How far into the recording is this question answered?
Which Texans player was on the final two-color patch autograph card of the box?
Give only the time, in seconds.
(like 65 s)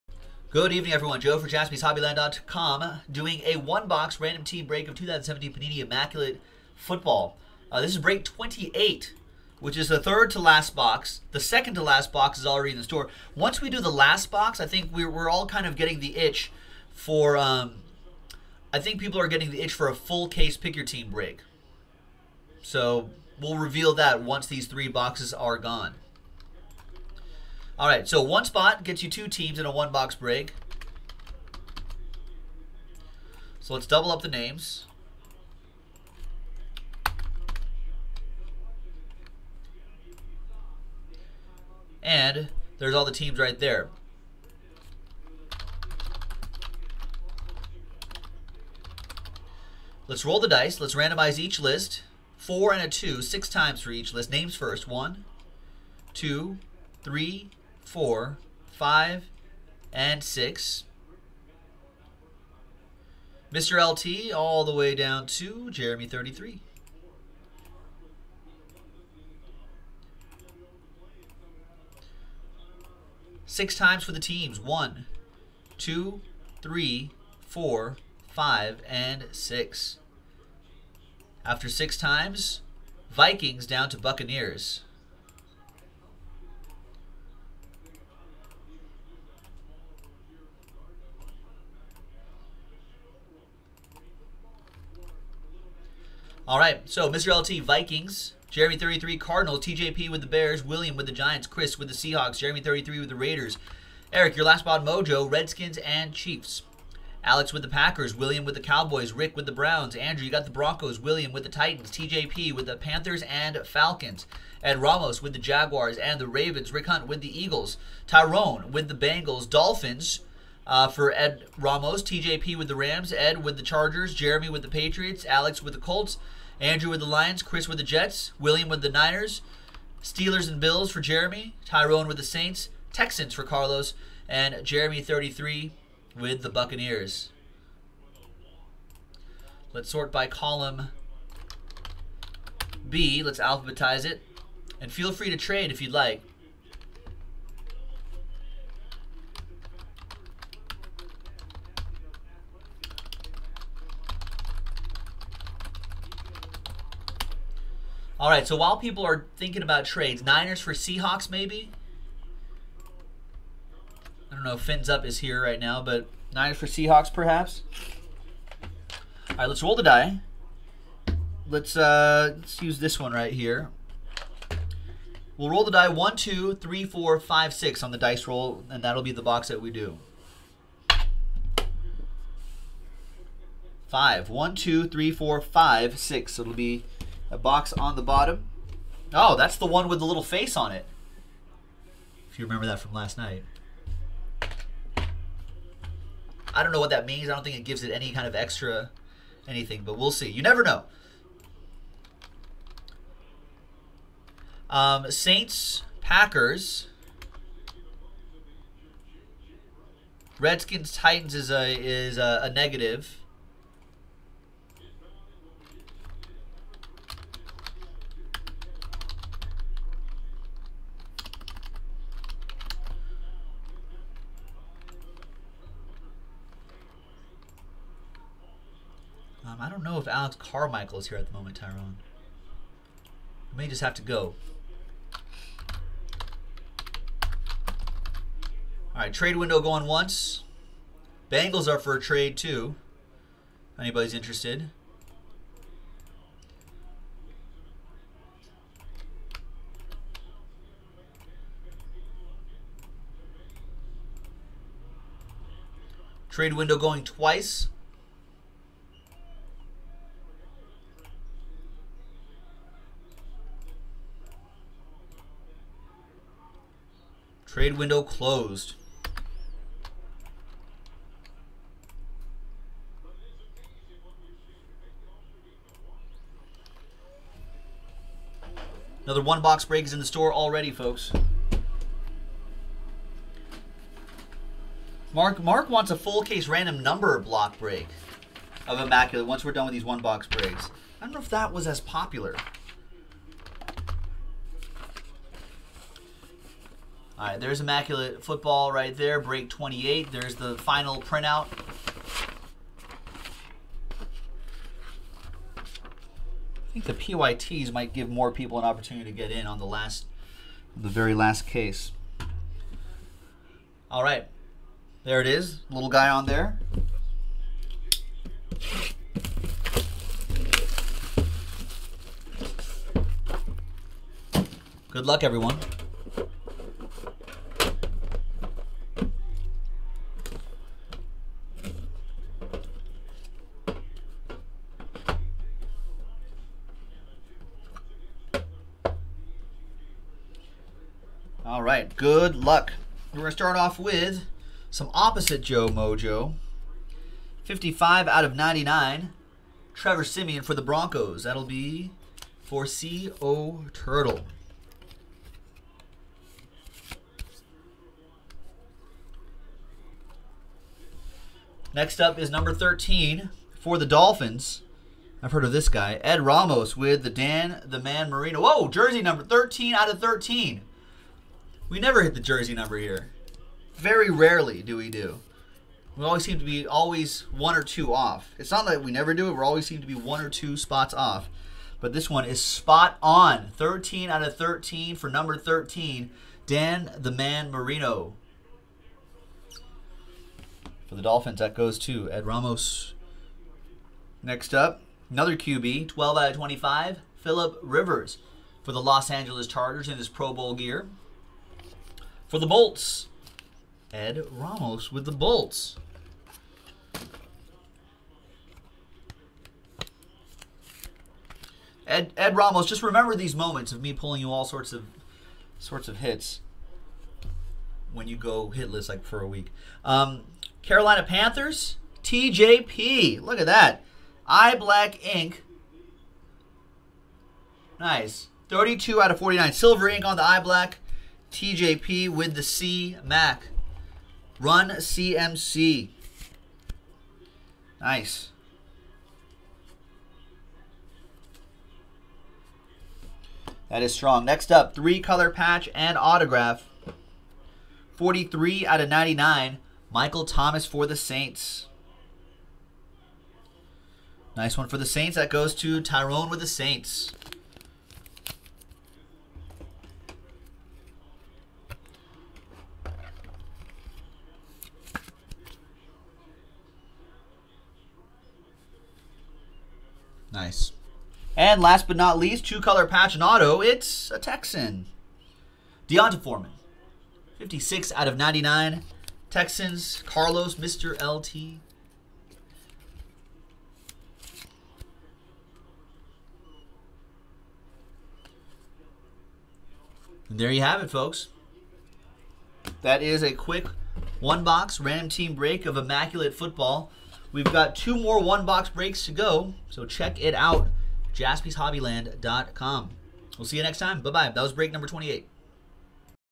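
475 s.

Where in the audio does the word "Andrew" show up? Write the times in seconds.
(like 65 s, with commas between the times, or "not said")
109 s, 126 s.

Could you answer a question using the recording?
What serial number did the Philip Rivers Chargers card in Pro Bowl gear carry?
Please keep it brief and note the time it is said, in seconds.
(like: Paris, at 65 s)
12 out of 25, at 395 s.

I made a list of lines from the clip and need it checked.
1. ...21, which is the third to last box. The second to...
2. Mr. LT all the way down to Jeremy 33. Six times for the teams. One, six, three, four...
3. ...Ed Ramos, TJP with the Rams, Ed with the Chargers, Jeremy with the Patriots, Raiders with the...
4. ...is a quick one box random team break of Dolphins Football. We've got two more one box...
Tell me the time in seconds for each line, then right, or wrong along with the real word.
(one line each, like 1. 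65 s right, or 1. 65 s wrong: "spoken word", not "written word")
1. 8 s wrong: "28", not "21"
2. 63 s wrong: "two", not "six"
3. 121 s wrong: "Alex", not "Raiders"
4. 493 s wrong: "Immaculate", not "Dolphins".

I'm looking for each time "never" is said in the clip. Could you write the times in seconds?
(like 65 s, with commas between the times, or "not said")
200 s, 371 s, 378 s.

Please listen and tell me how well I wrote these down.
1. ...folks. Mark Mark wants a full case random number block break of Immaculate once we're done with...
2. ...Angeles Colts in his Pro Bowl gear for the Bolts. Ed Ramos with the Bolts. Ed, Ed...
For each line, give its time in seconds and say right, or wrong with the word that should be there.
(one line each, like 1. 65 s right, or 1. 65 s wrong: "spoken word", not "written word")
1. 280 s right
2. 399 s wrong: "Chargers", not "Colts".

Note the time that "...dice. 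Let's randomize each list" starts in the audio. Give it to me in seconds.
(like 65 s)
50 s.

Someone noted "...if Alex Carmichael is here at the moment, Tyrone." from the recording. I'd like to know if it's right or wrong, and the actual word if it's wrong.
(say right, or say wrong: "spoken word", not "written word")
right.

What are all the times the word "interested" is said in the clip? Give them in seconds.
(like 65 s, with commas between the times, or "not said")
244 s.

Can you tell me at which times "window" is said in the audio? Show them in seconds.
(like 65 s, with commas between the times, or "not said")
239 s, 256 s, 267 s.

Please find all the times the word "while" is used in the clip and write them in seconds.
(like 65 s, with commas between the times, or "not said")
158 s.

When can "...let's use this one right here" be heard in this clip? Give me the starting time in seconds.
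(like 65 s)
172 s.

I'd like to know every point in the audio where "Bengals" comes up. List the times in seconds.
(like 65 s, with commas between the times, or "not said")
118 s, 241 s.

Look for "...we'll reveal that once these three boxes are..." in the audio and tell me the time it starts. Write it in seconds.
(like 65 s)
23 s.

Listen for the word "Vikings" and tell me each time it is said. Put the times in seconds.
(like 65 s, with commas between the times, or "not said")
83 s, 97 s.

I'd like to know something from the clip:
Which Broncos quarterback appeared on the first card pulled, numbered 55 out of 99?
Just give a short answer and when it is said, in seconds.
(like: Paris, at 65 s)
Trevor Siemian, at 349 s.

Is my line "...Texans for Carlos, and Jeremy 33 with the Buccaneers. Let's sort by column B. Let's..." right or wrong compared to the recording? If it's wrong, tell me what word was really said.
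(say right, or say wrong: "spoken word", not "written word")
right.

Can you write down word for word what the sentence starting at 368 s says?
Whoa, jersey number 13 out of 13.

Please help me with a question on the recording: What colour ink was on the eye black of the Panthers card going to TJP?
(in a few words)
Silver.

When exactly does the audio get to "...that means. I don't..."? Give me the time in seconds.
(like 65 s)
196 s.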